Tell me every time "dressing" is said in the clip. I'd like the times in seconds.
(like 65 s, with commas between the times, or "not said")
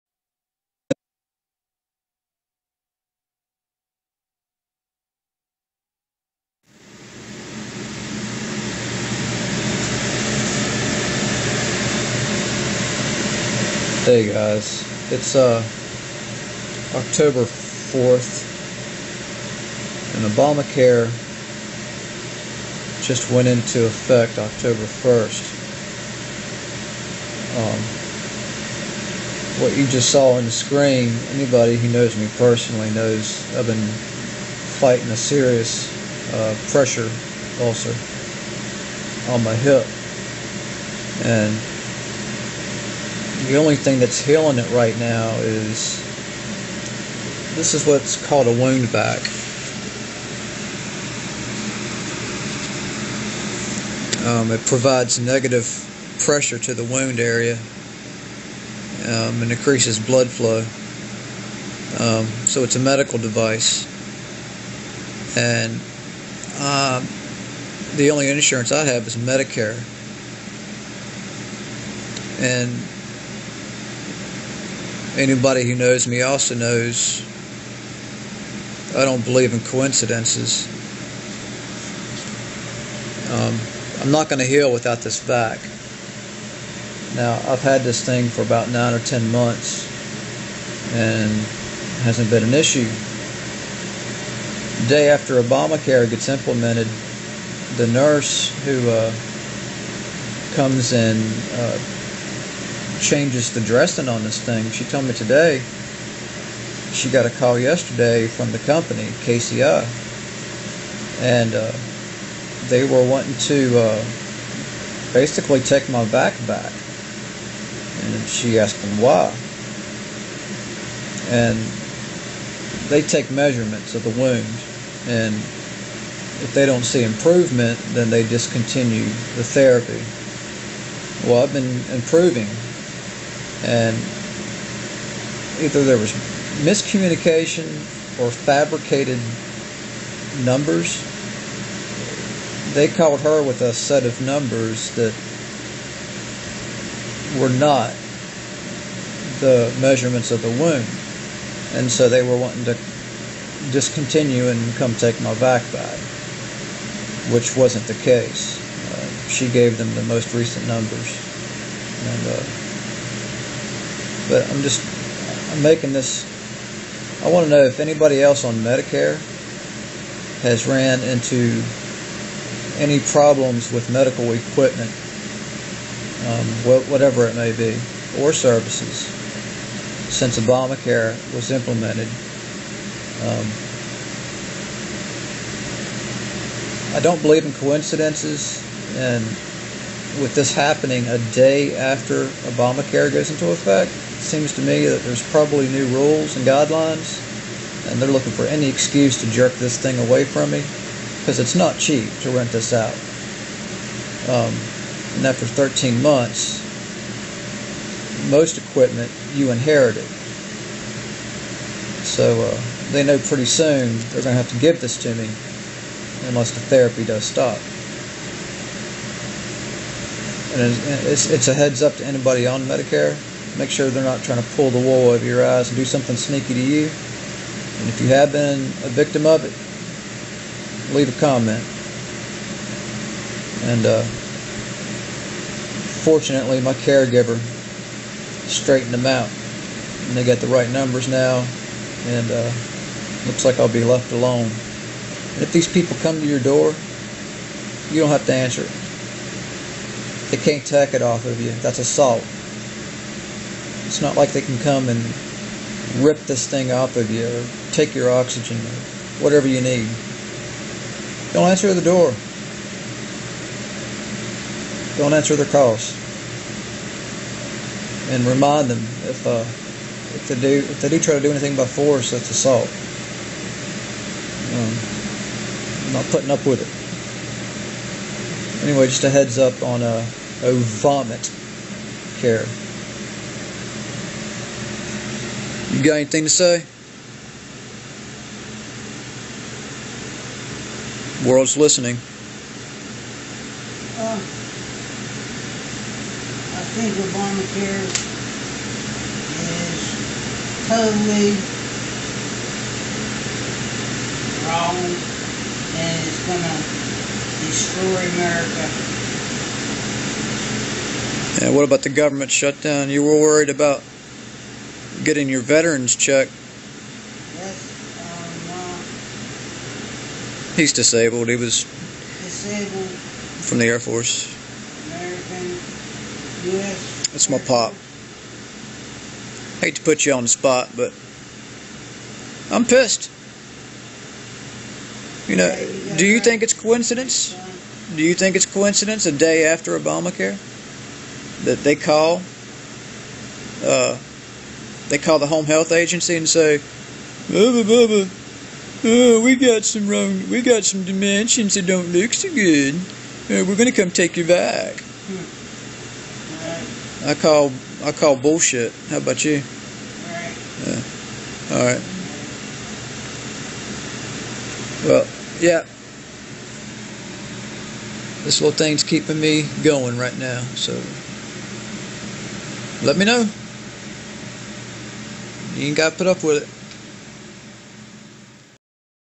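103 s.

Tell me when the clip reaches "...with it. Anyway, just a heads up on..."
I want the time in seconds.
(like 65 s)
276 s.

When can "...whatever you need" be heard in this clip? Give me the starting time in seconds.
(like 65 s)
259 s.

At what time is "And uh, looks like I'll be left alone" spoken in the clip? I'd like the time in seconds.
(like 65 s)
242 s.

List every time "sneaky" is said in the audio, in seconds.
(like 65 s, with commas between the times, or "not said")
226 s.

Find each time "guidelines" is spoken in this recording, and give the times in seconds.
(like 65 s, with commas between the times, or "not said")
196 s.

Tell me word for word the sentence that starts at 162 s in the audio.
And, uh, but I'm just I'm making this.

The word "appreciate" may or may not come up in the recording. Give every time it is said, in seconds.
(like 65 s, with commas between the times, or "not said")
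not said.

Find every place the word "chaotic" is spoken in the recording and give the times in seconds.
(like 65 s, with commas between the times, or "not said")
not said.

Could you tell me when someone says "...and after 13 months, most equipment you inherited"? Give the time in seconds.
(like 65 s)
205 s.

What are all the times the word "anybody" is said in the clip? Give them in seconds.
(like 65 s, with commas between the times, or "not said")
31 s, 75 s, 167 s, 222 s.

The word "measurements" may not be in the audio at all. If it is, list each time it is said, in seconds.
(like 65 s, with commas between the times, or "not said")
123 s, 149 s.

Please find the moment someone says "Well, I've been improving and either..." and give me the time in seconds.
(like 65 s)
131 s.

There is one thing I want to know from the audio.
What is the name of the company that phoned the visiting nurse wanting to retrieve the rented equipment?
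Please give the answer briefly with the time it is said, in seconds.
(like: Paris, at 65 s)
KCI, at 109 s.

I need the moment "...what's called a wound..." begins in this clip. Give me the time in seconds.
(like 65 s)
47 s.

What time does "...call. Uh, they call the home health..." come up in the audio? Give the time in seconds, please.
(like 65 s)
341 s.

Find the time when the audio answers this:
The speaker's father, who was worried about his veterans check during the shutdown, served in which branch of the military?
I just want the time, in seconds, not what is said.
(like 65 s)
323 s.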